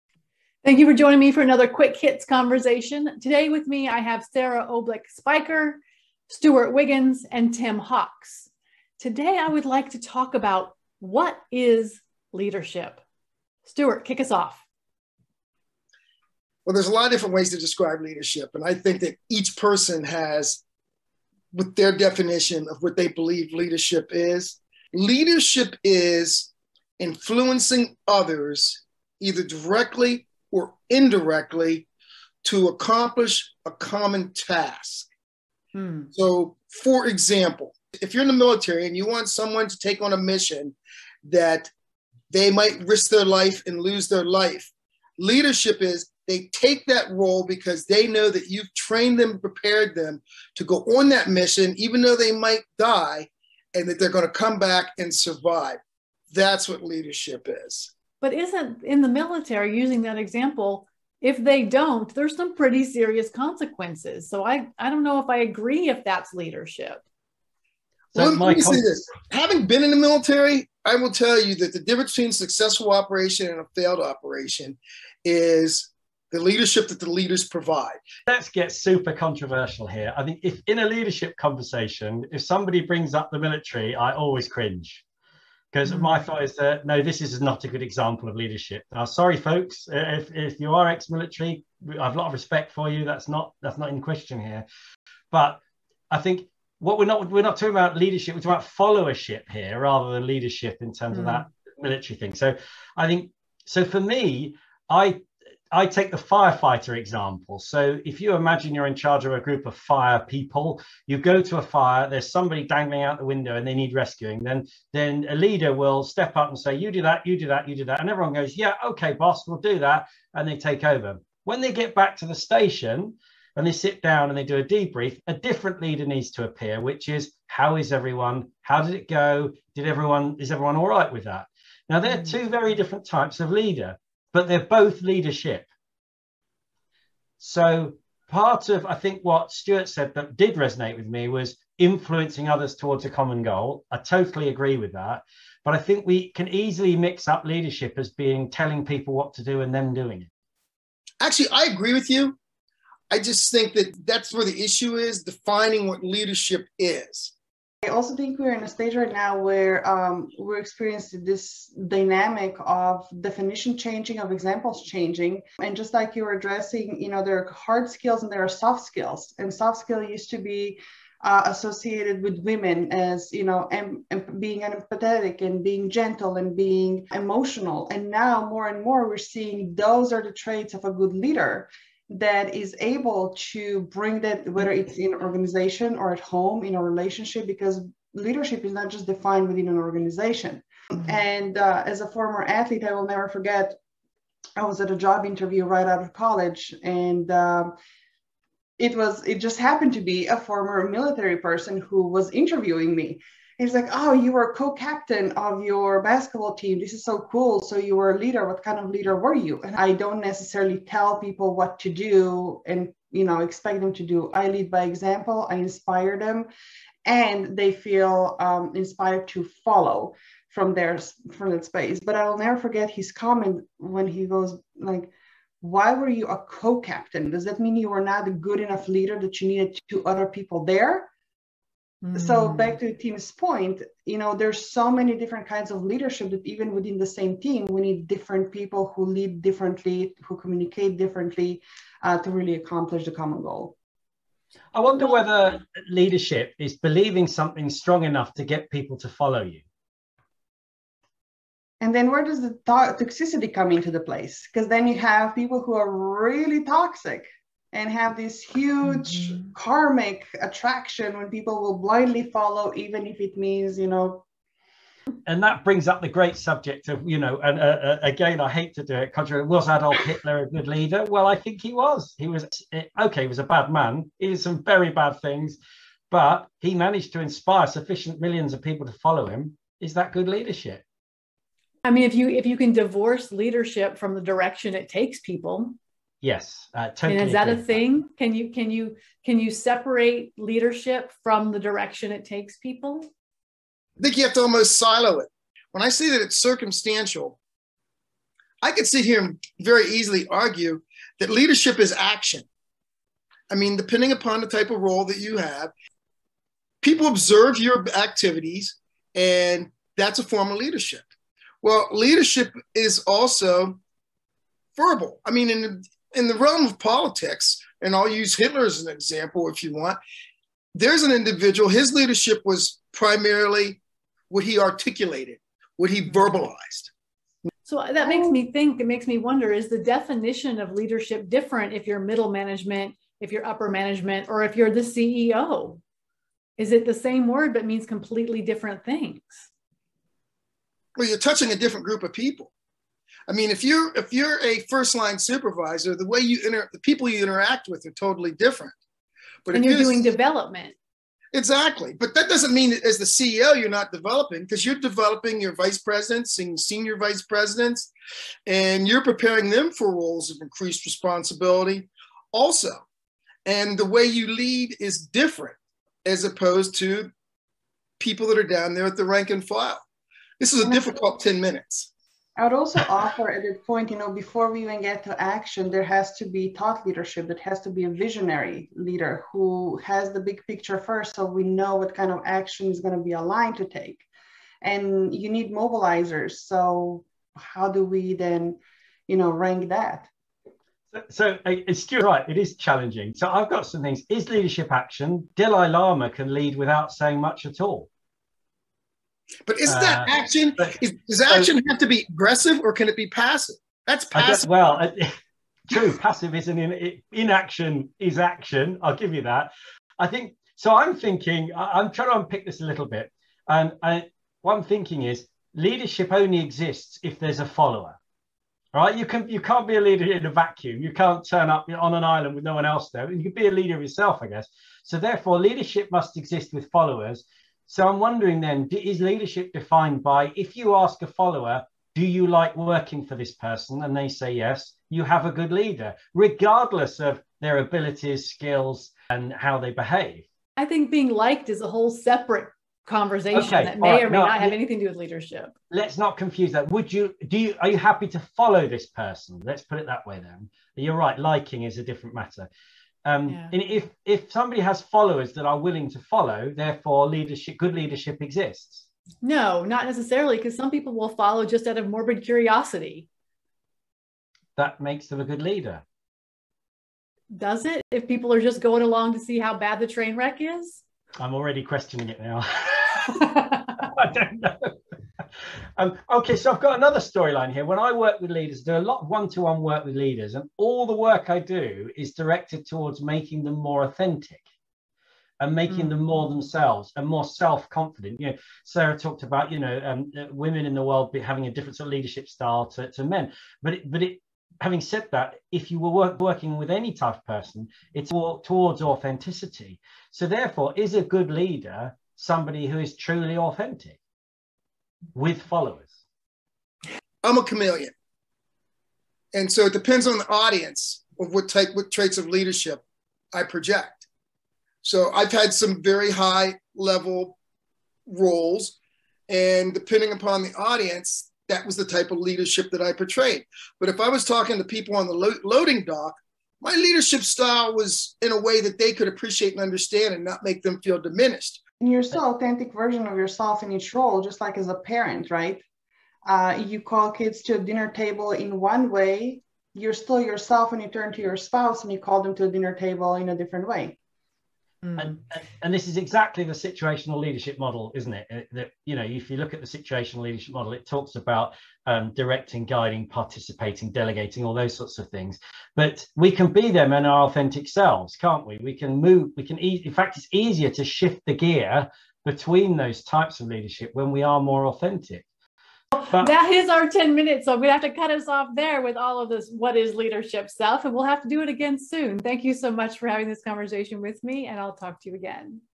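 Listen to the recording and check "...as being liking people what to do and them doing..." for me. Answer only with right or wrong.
wrong.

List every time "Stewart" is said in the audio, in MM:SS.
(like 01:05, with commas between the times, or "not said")
00:06, 00:13, 02:19, 06:31.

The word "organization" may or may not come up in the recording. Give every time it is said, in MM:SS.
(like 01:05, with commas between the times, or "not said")
03:05, 03:09.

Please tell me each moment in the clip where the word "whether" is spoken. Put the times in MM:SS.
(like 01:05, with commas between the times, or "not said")
03:04, 04:05.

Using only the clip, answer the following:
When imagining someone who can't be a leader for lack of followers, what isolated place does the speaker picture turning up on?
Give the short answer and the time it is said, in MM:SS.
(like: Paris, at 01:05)
An island, at 07:02.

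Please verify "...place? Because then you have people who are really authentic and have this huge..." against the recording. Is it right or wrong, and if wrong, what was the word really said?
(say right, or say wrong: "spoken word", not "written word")
wrong: "toxic", not "authentic".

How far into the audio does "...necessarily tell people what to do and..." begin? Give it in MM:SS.
03:30.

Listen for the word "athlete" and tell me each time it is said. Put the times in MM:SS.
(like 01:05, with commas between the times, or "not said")
03:12.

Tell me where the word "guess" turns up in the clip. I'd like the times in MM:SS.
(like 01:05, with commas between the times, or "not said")
06:44, 07:04.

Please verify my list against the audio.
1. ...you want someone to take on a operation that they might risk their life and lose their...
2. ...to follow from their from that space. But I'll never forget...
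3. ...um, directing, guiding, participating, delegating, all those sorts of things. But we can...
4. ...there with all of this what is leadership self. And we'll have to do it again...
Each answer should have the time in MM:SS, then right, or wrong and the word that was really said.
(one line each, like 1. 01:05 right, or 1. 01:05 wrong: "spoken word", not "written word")
1. 00:38 wrong: "mission", not "operation"
2. 03:39 right
3. 09:11 right
4. 09:28 right.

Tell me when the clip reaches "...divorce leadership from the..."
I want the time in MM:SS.
04:42.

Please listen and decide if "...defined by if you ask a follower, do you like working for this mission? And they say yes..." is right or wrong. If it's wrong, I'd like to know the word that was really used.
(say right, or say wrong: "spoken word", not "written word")
wrong: "person", not "mission".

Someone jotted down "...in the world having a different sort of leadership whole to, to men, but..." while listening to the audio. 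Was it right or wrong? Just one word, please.
wrong.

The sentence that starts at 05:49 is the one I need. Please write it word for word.
But and you're, you're doing development.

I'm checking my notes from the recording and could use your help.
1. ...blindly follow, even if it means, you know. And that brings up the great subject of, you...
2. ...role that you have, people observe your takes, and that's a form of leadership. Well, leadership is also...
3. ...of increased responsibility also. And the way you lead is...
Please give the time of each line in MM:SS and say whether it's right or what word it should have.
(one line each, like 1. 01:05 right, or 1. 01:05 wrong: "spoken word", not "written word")
1. 04:21 right
2. 05:04 wrong: "activities", not "takes"
3. 06:00 right.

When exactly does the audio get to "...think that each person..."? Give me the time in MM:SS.
00:18.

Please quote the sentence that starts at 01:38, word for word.
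We're talking about followership here, rather than leadership in terms mm of that military thing.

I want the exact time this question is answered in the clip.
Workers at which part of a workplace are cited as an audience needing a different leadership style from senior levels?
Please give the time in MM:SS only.
08:45.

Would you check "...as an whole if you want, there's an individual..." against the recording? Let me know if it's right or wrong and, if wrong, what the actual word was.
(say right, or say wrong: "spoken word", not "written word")
wrong: "example", not "whole".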